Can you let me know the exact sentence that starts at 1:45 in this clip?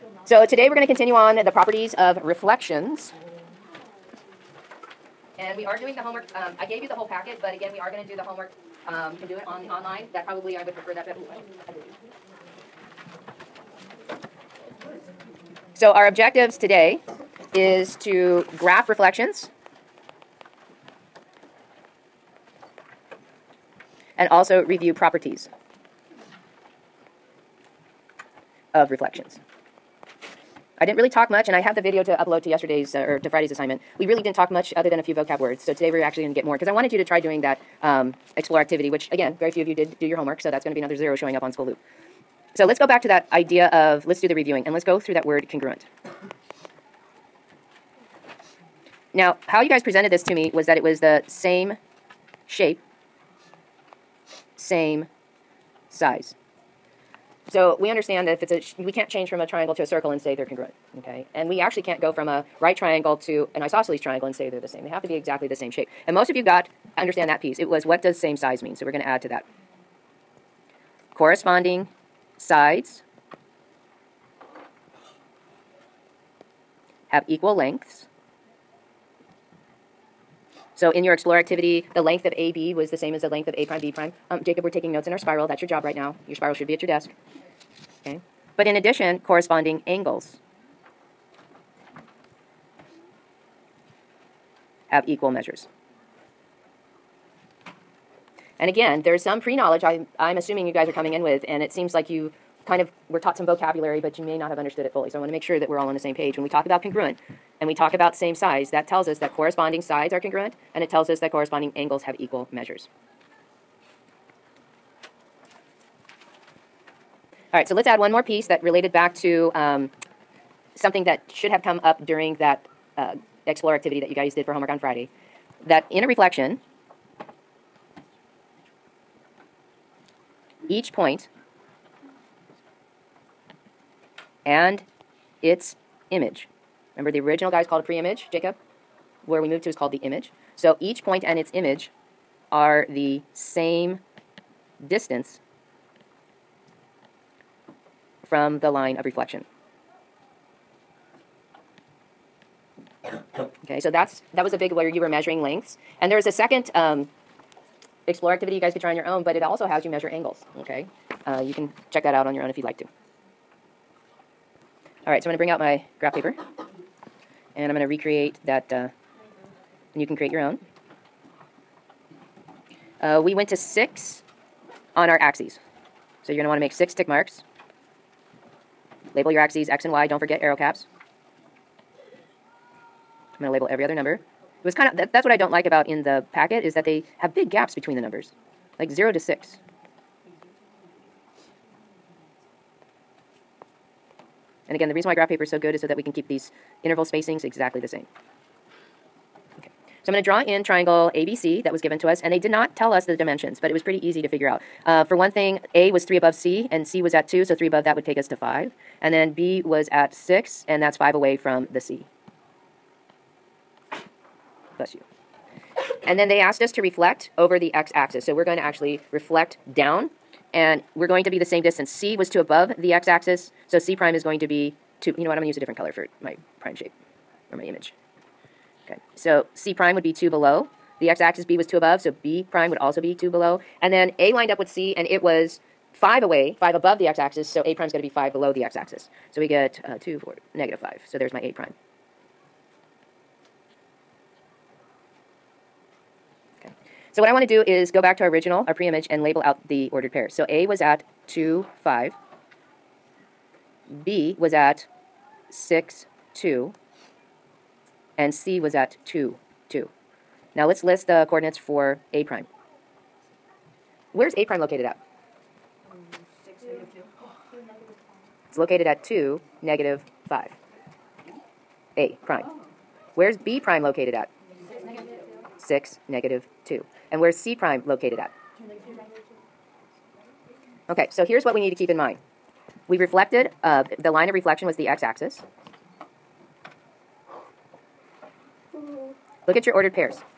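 So I want to make sure that we're all on the same page.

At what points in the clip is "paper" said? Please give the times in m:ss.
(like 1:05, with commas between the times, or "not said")
2:46, 3:15.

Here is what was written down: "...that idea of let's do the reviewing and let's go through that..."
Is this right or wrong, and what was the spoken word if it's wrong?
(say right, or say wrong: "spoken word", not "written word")
right.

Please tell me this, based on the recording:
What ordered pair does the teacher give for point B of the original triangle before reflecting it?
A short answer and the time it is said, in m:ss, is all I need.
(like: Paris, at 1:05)
6, 2, at 4:14.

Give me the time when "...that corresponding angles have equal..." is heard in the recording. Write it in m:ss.
1:51.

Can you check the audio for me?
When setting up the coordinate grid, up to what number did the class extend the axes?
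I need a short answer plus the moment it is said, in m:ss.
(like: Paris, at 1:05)
6, at 2:53.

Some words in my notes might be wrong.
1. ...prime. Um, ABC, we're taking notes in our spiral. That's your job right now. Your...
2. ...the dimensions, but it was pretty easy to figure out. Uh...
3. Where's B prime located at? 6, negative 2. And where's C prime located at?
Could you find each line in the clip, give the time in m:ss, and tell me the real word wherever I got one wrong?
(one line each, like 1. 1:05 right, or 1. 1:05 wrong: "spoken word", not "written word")
1. 1:23 wrong: "Jacob", not "ABC"
2. 3:23 right
3. 4:33 right.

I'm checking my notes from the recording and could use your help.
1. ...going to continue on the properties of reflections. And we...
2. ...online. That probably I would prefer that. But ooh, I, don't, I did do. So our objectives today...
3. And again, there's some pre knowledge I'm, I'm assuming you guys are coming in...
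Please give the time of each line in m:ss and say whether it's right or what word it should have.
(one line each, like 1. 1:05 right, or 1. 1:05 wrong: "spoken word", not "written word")
1. 0:00 right
2. 0:09 right
3. 1:38 right.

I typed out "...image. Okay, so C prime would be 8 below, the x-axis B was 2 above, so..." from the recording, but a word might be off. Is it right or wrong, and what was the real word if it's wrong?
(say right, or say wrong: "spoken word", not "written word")
wrong: "2", not "8".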